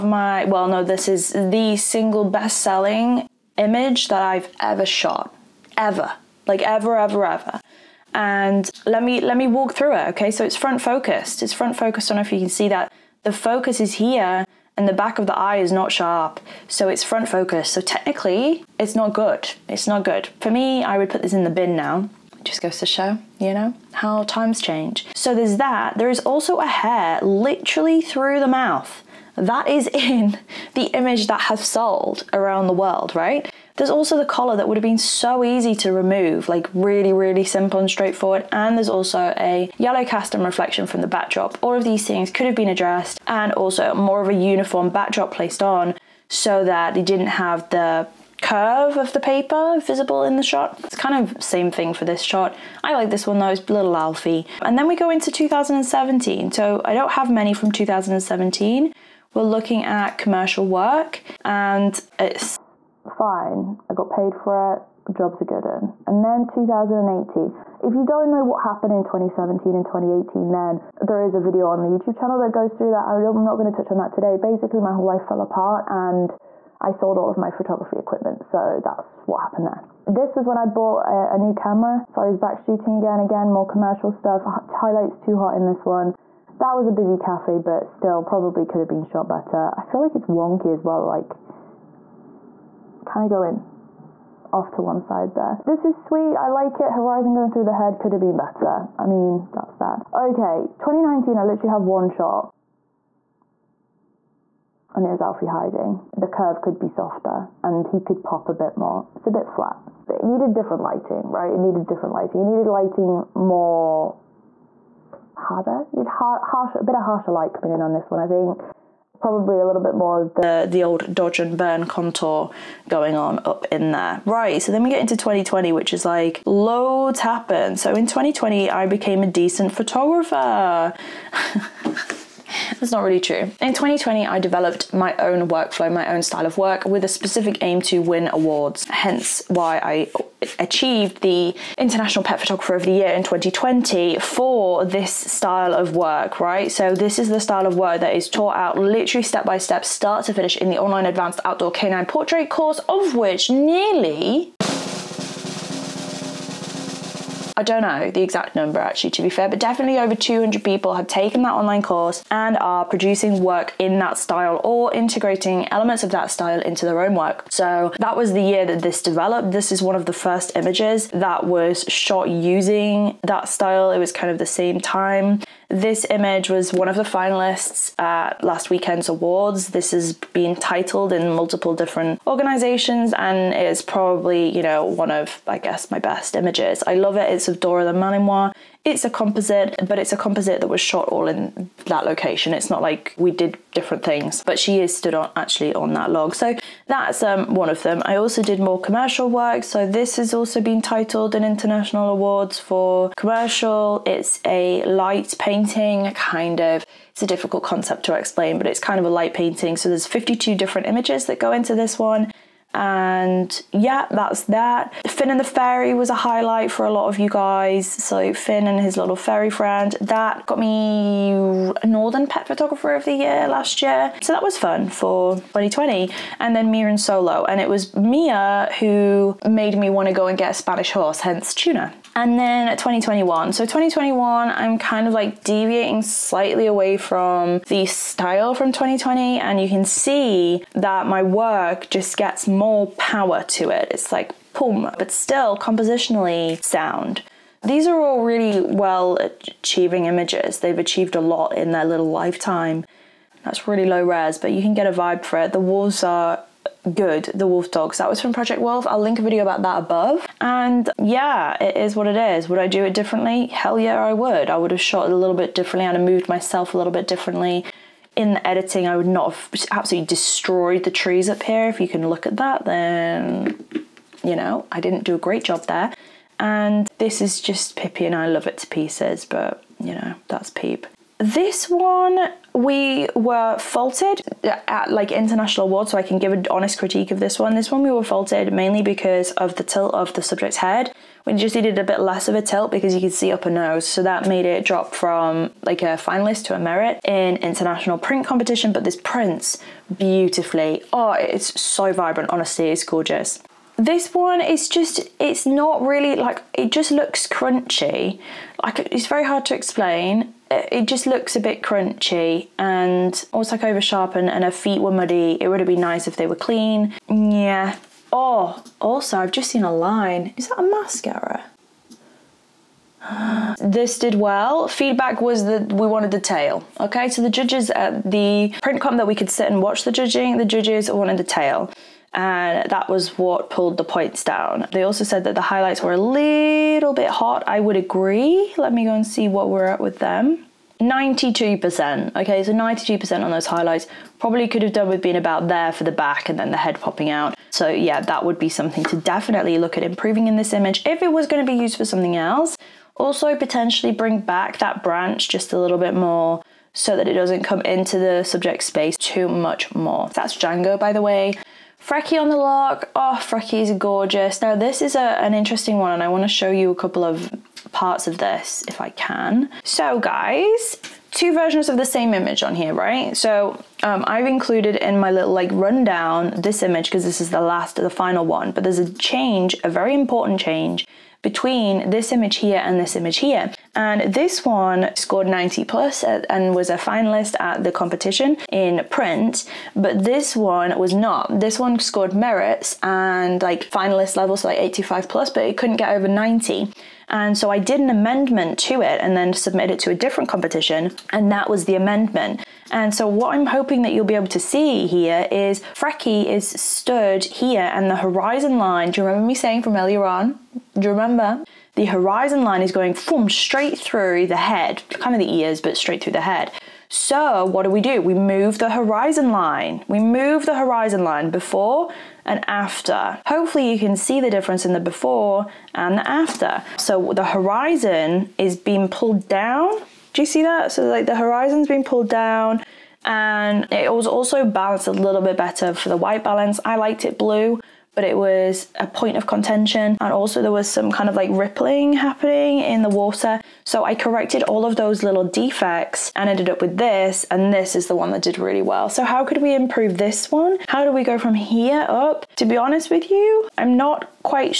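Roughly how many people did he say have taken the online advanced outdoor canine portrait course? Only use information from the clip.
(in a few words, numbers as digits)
Over 200.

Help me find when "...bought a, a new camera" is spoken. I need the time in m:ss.
1:20.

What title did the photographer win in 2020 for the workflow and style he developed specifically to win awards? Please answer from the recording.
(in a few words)
International Pet Photographer of the Year.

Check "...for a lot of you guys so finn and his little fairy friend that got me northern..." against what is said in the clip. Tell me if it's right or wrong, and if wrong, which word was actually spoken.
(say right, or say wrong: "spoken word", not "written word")
right.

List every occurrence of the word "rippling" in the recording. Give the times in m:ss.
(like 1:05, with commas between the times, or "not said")
7:21.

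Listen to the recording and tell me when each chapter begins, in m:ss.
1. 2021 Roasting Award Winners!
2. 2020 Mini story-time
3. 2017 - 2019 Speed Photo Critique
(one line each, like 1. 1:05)
1. 3:51
2. 2:03
3. 0:53.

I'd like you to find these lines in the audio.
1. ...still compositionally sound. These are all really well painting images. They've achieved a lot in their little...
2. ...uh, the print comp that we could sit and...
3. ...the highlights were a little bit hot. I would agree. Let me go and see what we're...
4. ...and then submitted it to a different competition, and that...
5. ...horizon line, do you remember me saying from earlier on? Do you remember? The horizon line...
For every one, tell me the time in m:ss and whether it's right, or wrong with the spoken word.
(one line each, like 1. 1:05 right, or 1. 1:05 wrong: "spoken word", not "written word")
1. 4:05 wrong: "achieving", not "painting"
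2. 5:27 right
3. 5:35 right
4. 6:39 right
5. 6:47 right.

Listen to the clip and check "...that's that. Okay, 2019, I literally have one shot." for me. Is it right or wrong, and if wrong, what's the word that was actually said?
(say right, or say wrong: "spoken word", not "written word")
right.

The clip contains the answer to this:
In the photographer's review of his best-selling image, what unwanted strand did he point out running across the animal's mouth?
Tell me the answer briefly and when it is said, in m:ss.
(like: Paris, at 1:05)
A hair, at 0:26.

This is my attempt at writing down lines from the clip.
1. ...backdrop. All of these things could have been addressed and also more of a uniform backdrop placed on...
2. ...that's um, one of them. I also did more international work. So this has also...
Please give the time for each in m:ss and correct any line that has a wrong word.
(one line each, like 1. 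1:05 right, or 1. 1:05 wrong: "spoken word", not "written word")
1. 0:41 right
2. 3:16 wrong: "commercial", not "international".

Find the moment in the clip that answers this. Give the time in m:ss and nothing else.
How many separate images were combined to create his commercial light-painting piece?
3:30.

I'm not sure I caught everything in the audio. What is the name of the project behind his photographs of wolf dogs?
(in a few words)
Project Wolf.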